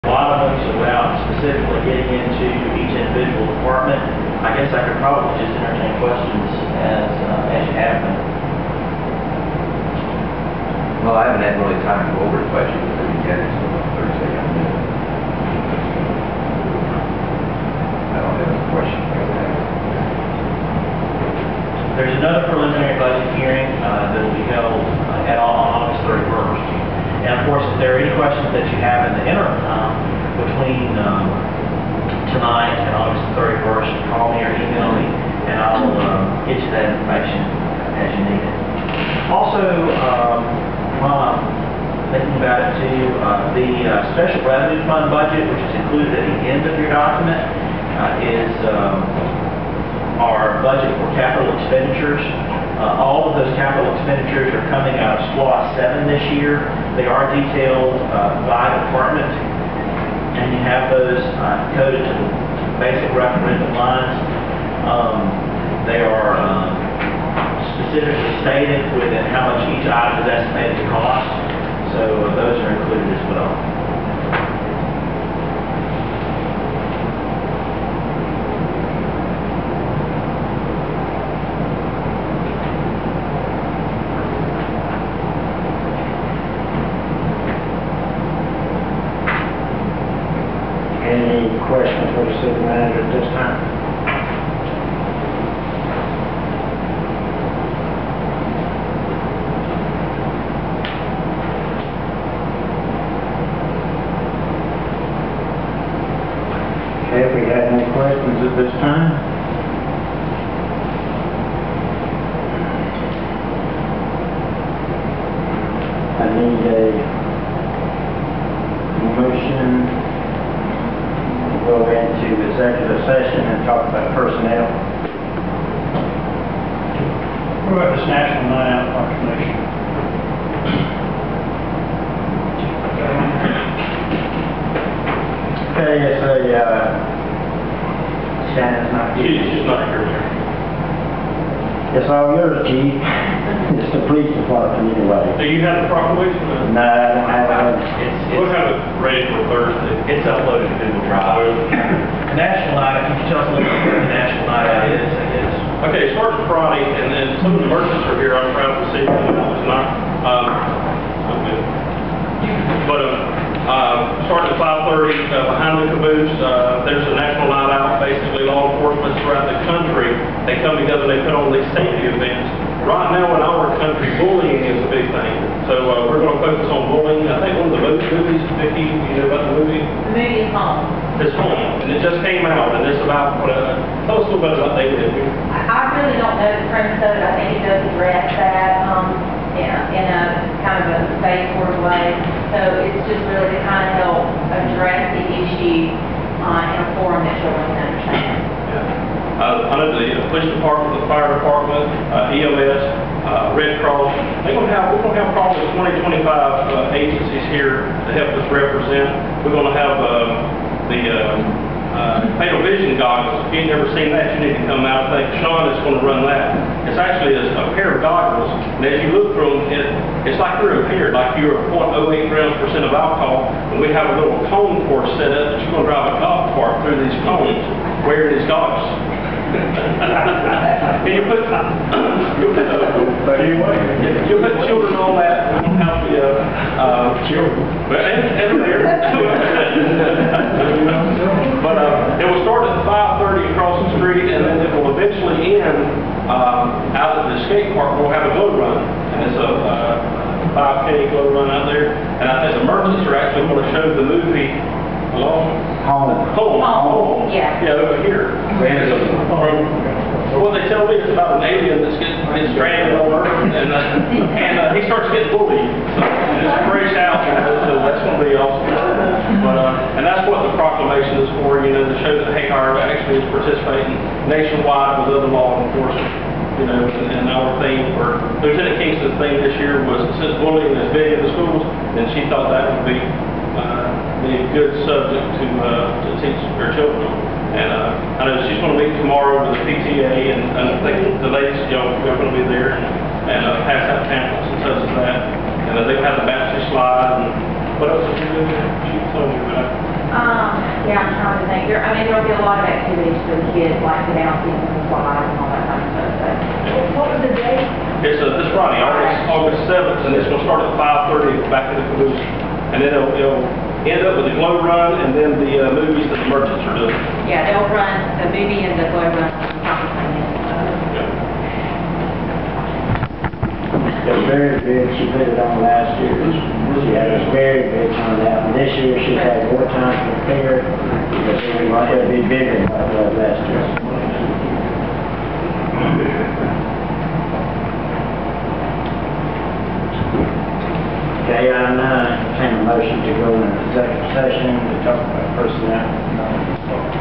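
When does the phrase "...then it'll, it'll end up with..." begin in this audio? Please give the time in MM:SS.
05:12.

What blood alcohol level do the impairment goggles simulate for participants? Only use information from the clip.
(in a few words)
0.08 grams percent.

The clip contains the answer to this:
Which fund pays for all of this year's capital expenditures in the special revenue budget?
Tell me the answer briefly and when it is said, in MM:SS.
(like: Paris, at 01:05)
SWA 7, at 00:55.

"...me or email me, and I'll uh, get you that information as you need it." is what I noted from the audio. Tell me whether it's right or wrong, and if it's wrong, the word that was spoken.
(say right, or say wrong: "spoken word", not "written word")
right.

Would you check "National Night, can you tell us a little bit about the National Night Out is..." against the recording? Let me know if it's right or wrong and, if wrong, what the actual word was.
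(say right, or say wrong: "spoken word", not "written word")
right.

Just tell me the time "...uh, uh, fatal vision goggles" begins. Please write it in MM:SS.
03:31.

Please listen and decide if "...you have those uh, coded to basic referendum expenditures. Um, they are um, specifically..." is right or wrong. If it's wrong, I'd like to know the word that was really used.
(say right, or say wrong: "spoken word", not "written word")
wrong: "lines", not "expenditures".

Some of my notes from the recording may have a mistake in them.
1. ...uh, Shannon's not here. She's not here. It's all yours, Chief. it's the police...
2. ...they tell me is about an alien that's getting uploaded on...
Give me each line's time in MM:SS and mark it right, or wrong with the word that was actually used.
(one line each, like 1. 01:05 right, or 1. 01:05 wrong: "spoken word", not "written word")
1. 02:16 right
2. 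04:20 wrong: "stranded", not "uploaded".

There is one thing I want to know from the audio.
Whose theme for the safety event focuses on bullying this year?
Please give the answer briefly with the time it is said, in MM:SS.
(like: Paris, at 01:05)
Lieutenant Kingston, at 04:38.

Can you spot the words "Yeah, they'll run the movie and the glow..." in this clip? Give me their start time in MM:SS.
05:17.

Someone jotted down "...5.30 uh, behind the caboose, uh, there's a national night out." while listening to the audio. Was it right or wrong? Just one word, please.
right.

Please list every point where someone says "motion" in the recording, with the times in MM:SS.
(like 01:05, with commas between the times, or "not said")
01:59, 05:42.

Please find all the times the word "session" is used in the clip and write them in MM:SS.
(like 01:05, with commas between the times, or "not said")
02:03, 05:44.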